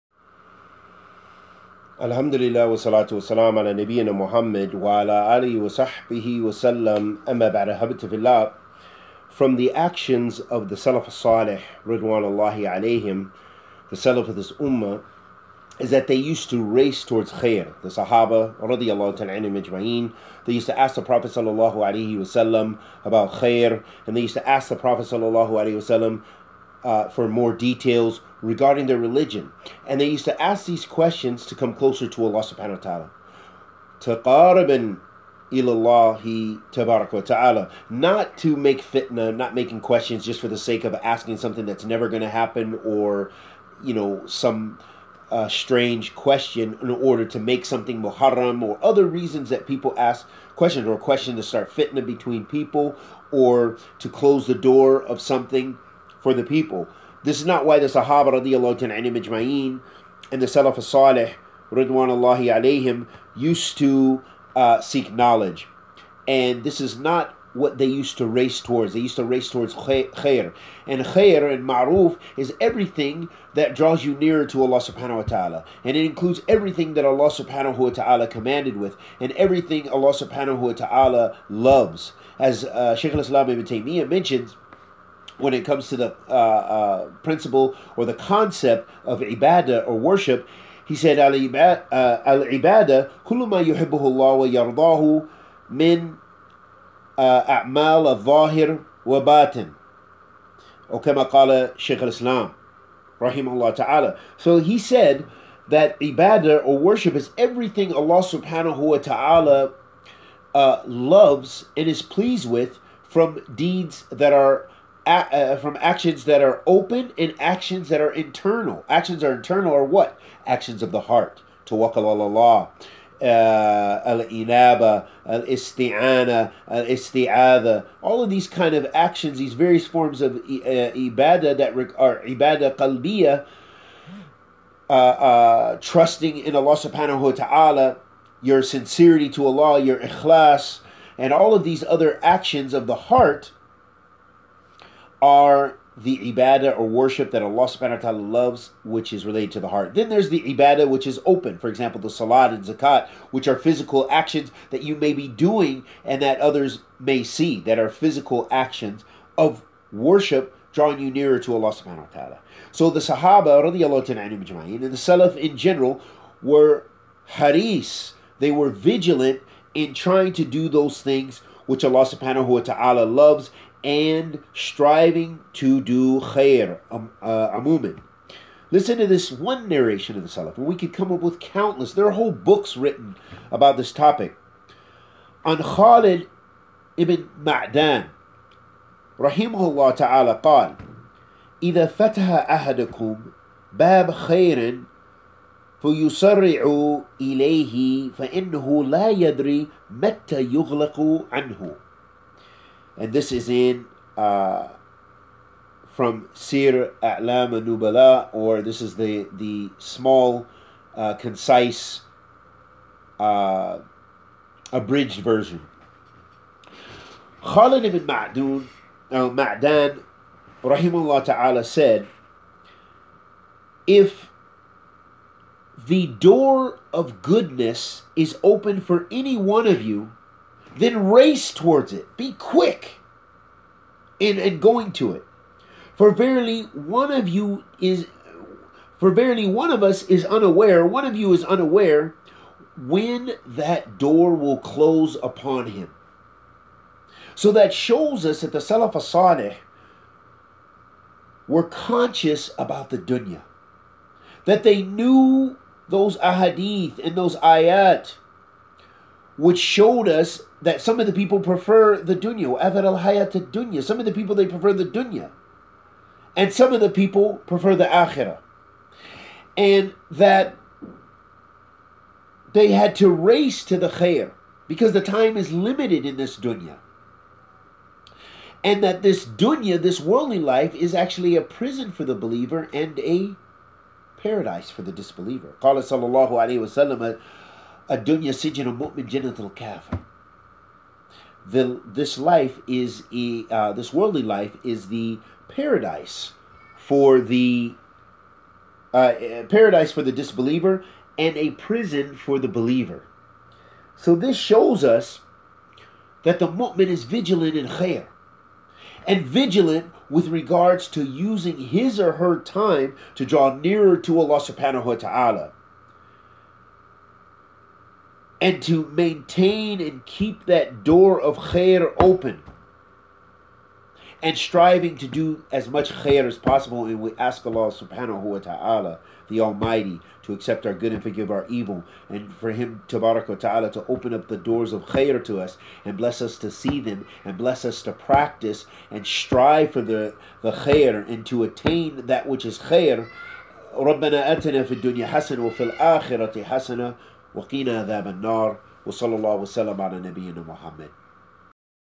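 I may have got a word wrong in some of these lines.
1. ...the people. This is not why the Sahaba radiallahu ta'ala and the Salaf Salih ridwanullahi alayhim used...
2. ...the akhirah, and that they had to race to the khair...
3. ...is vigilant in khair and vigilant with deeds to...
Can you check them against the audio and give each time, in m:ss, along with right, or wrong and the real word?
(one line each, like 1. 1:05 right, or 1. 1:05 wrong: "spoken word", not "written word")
1. 0:56 right
2. 4:27 right
3. 5:06 wrong: "regards", not "deeds".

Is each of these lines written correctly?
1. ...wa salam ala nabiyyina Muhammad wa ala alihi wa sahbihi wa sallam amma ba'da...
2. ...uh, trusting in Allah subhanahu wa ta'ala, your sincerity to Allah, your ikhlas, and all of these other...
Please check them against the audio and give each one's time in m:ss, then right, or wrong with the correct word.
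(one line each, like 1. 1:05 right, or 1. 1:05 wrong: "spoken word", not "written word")
1. 0:03 right
2. 2:14 right.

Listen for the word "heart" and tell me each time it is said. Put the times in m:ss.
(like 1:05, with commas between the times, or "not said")
2:01, 2:23, 2:29.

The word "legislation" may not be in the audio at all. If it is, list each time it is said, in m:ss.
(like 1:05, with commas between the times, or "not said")
not said.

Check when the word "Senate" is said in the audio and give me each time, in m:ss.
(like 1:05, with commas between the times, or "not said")
not said.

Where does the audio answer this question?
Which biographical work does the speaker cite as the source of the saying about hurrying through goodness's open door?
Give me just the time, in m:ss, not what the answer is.
3:26.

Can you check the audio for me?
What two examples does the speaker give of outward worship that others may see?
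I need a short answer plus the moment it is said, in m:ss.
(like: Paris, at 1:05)
Salat and zakat, at 2:32.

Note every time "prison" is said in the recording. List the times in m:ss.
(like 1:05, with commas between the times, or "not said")
4:41, 5:01.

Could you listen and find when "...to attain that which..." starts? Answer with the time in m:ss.
5:41.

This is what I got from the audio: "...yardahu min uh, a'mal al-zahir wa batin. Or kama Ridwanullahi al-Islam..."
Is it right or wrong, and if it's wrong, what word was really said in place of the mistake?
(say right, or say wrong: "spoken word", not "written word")
wrong: "Shaykh", not "Ridwanullahi".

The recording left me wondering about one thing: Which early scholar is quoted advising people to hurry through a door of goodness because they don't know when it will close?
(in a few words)
Khalid ibn Ma'dan.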